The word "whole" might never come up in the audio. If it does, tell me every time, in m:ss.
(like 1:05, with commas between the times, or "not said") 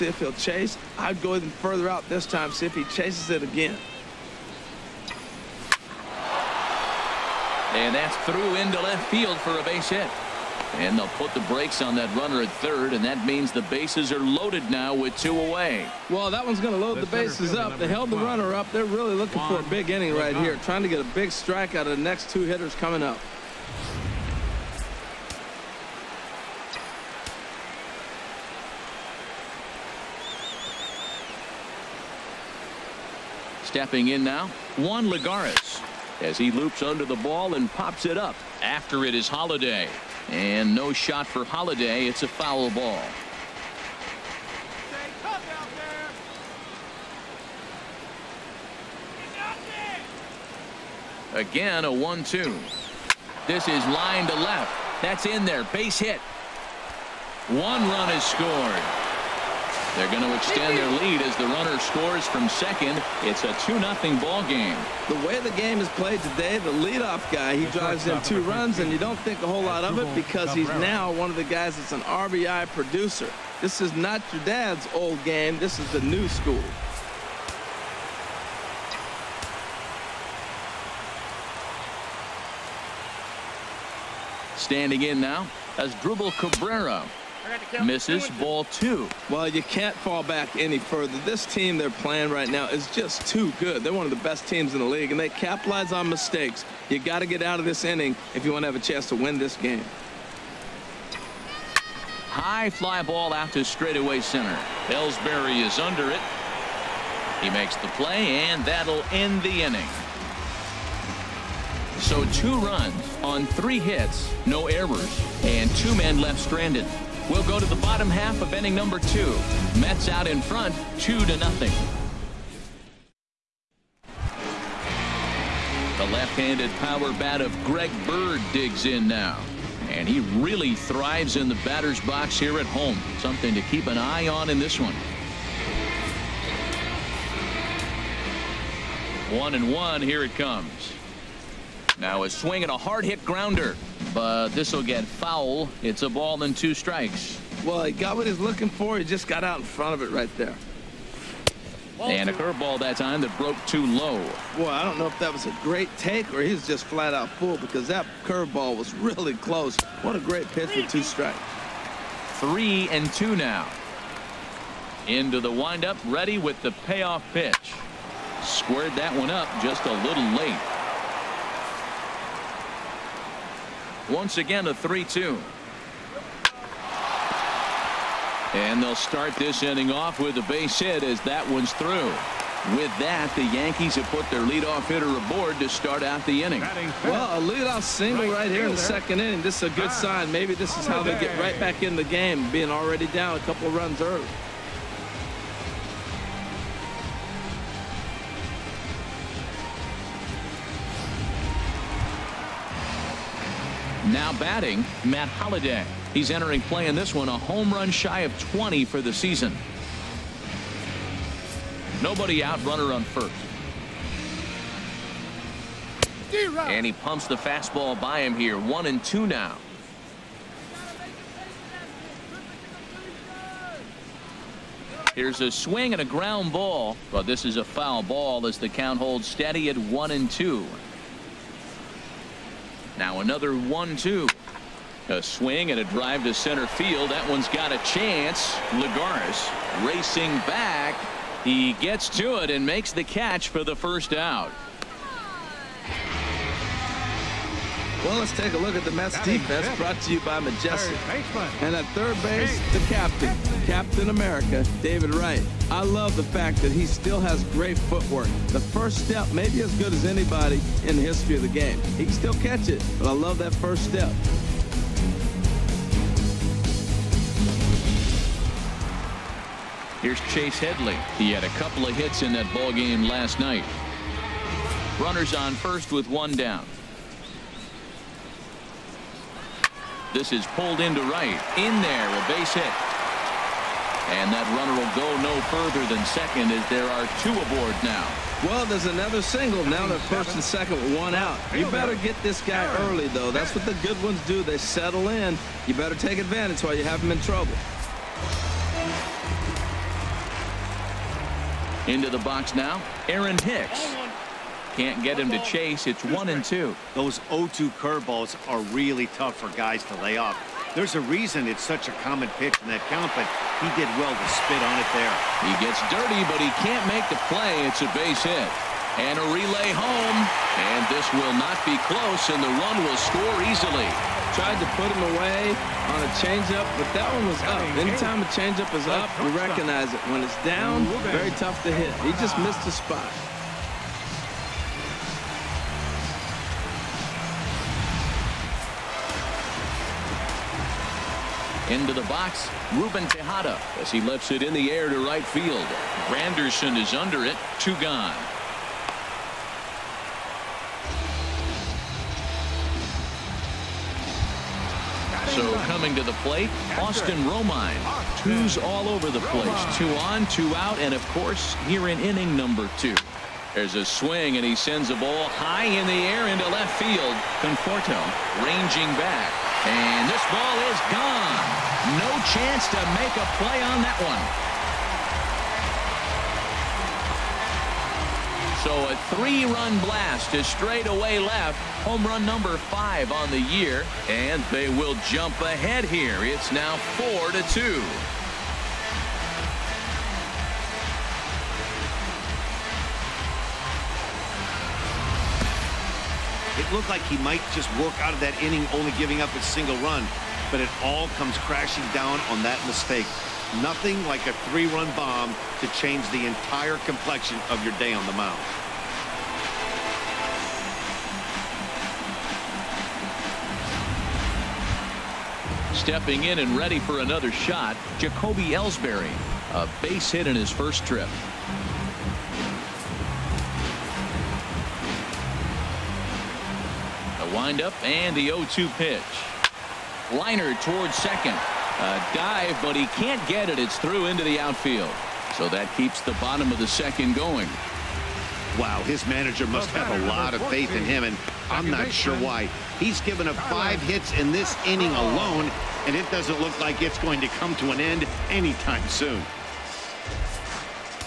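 1:09.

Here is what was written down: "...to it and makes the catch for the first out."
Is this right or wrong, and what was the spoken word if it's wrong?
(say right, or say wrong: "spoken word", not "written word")
right.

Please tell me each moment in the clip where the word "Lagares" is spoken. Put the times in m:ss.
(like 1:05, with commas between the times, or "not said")
0:35, 3:58.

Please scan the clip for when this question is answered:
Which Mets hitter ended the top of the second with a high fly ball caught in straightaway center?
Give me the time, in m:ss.
1:25.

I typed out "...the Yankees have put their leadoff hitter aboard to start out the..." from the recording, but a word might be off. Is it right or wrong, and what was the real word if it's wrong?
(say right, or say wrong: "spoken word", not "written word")
right.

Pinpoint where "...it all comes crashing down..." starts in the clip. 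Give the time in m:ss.
6:40.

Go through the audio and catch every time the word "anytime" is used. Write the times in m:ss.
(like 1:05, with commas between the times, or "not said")
5:27, 7:28.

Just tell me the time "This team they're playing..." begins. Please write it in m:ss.
1:31.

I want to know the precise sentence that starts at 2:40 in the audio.
What a great pitch for two strikes.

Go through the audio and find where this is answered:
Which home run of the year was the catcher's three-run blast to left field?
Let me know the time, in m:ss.
6:21.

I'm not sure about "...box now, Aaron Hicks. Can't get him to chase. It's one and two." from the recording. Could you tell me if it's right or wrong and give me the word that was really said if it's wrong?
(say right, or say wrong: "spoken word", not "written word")
right.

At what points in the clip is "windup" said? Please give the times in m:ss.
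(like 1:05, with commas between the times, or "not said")
2:45, 7:07.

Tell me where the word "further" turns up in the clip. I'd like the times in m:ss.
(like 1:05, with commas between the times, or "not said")
0:01, 1:30, 4:45.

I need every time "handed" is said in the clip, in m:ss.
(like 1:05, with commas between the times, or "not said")
2:06.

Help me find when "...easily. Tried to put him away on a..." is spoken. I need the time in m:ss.
5:23.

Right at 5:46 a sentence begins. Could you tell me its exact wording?
Granderson is under it, two gone.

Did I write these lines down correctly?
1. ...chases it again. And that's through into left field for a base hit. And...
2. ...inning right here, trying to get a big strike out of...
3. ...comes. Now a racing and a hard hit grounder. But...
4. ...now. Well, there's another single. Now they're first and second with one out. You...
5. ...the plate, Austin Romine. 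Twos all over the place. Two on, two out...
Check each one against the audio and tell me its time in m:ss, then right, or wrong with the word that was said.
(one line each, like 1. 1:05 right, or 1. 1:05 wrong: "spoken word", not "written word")
1. 0:02 right
2. 0:19 right
3. 2:20 wrong: "swing", not "racing"
4. 4:47 right
5. 5:56 right.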